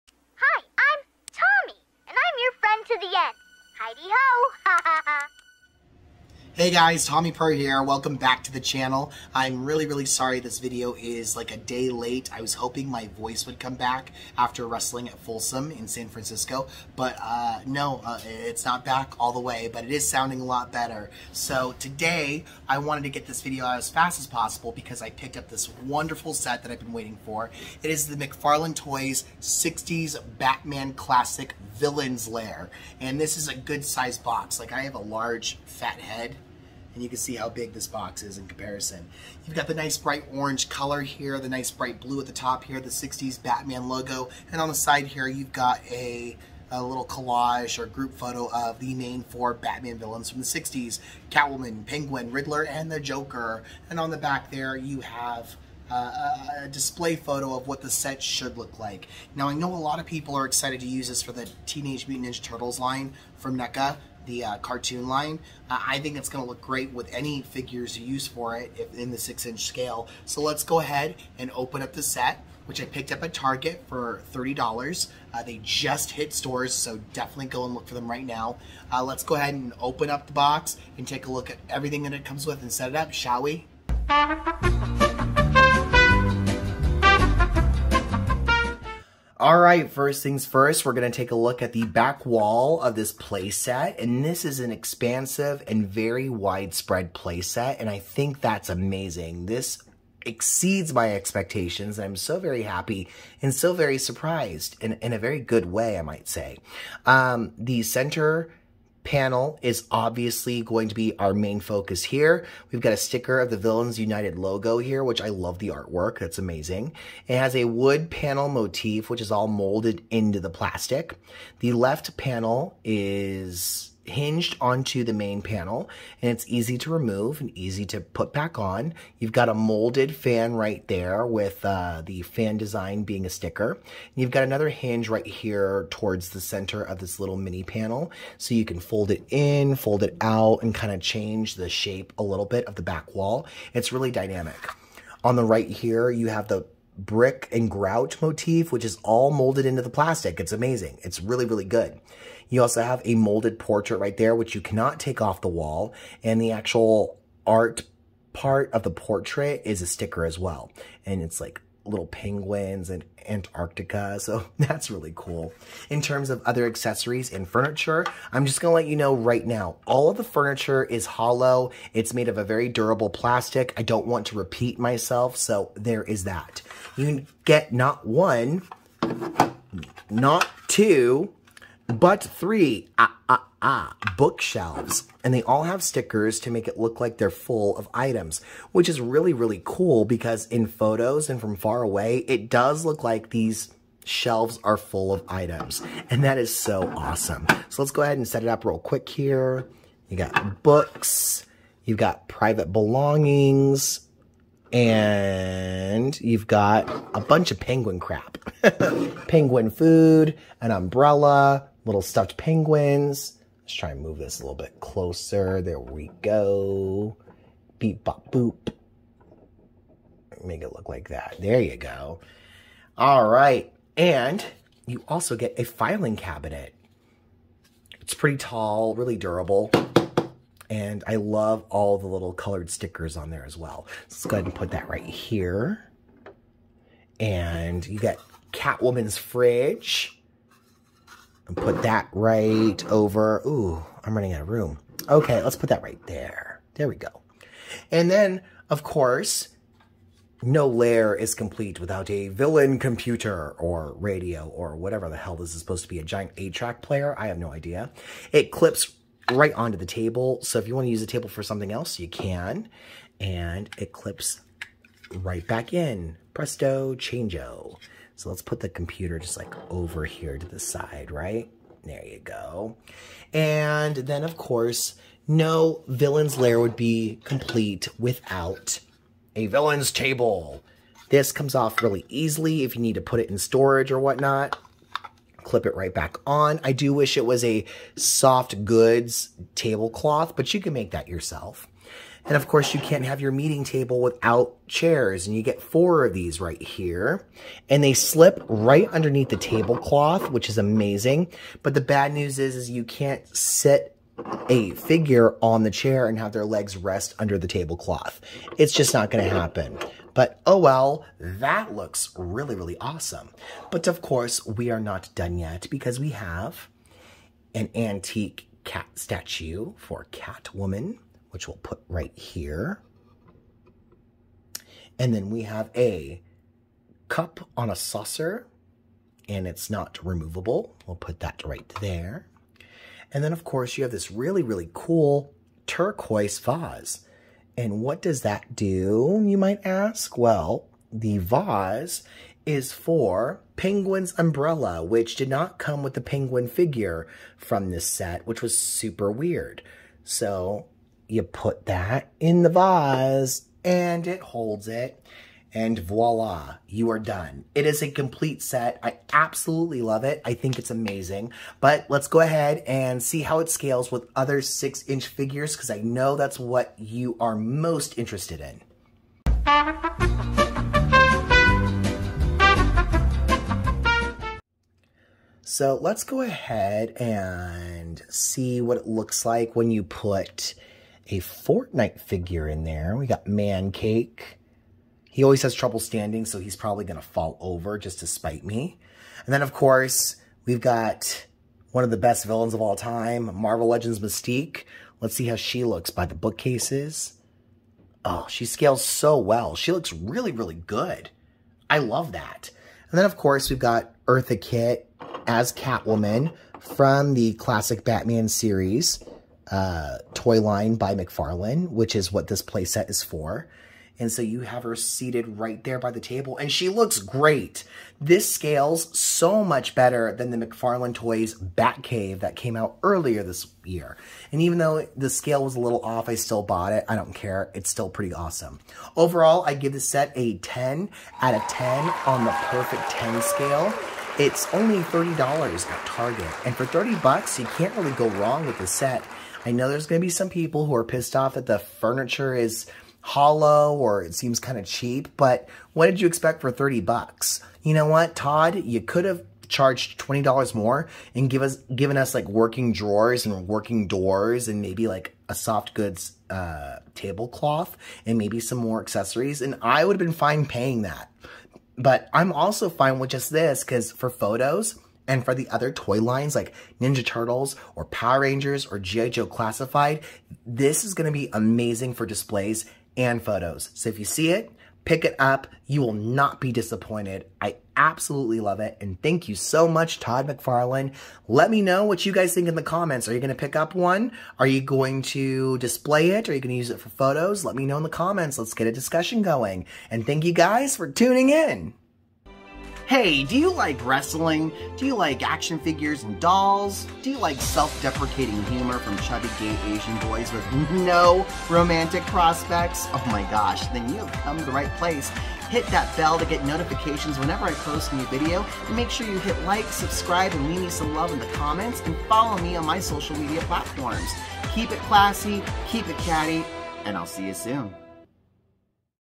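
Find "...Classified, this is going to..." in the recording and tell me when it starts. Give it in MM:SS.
07:49.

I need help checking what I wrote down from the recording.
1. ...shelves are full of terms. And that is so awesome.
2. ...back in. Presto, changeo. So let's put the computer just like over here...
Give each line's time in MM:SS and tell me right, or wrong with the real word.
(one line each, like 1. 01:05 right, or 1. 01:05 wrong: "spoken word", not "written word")
1. 03:14 wrong: "items", not "terms"
2. 04:25 right.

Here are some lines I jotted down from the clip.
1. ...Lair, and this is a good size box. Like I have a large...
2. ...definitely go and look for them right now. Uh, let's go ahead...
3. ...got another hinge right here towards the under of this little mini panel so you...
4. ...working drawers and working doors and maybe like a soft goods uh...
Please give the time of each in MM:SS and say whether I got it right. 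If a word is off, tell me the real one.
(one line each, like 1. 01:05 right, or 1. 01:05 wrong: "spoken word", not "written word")
1. 00:32 right
2. 01:17 right
3. 02:14 wrong: "center", not "under"
4. 07:32 right.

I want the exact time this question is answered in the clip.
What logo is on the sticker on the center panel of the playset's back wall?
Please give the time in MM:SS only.
01:53.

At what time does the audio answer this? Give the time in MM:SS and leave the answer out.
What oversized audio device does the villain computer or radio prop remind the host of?
04:16.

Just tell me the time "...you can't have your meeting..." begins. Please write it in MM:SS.
04:52.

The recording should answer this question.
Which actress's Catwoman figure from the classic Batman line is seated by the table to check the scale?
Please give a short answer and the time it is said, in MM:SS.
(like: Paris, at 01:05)
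Eartha Kitt, at 06:44.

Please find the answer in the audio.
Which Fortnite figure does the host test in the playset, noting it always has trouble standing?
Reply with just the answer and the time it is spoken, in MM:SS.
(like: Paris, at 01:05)
Mancake, at 06:23.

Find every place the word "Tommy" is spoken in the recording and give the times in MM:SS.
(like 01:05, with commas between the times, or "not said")
00:07.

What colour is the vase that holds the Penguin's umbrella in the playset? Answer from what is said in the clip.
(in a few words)
Turquoise.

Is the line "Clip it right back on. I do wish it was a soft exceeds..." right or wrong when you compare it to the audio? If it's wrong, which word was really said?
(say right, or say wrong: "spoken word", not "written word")
wrong: "goods", not "exceeds".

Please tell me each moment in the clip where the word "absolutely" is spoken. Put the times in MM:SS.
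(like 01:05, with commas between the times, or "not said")
05:59, 07:57.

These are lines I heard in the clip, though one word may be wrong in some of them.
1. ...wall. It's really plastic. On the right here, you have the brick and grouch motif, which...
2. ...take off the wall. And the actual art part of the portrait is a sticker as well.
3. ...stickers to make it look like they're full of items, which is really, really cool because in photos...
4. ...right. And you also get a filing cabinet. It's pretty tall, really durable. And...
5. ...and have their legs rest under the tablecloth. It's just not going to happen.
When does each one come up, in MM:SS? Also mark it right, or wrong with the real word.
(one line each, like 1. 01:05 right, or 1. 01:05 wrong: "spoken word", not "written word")
1. 02:23 wrong: "dynamic", not "plastic"
2. 02:34 right
3. 03:05 right
4. 03:43 right
5. 05:06 right.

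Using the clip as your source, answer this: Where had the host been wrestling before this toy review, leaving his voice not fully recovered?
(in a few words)
Folsom in San Francisco.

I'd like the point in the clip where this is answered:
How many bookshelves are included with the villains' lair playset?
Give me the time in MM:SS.
03:02.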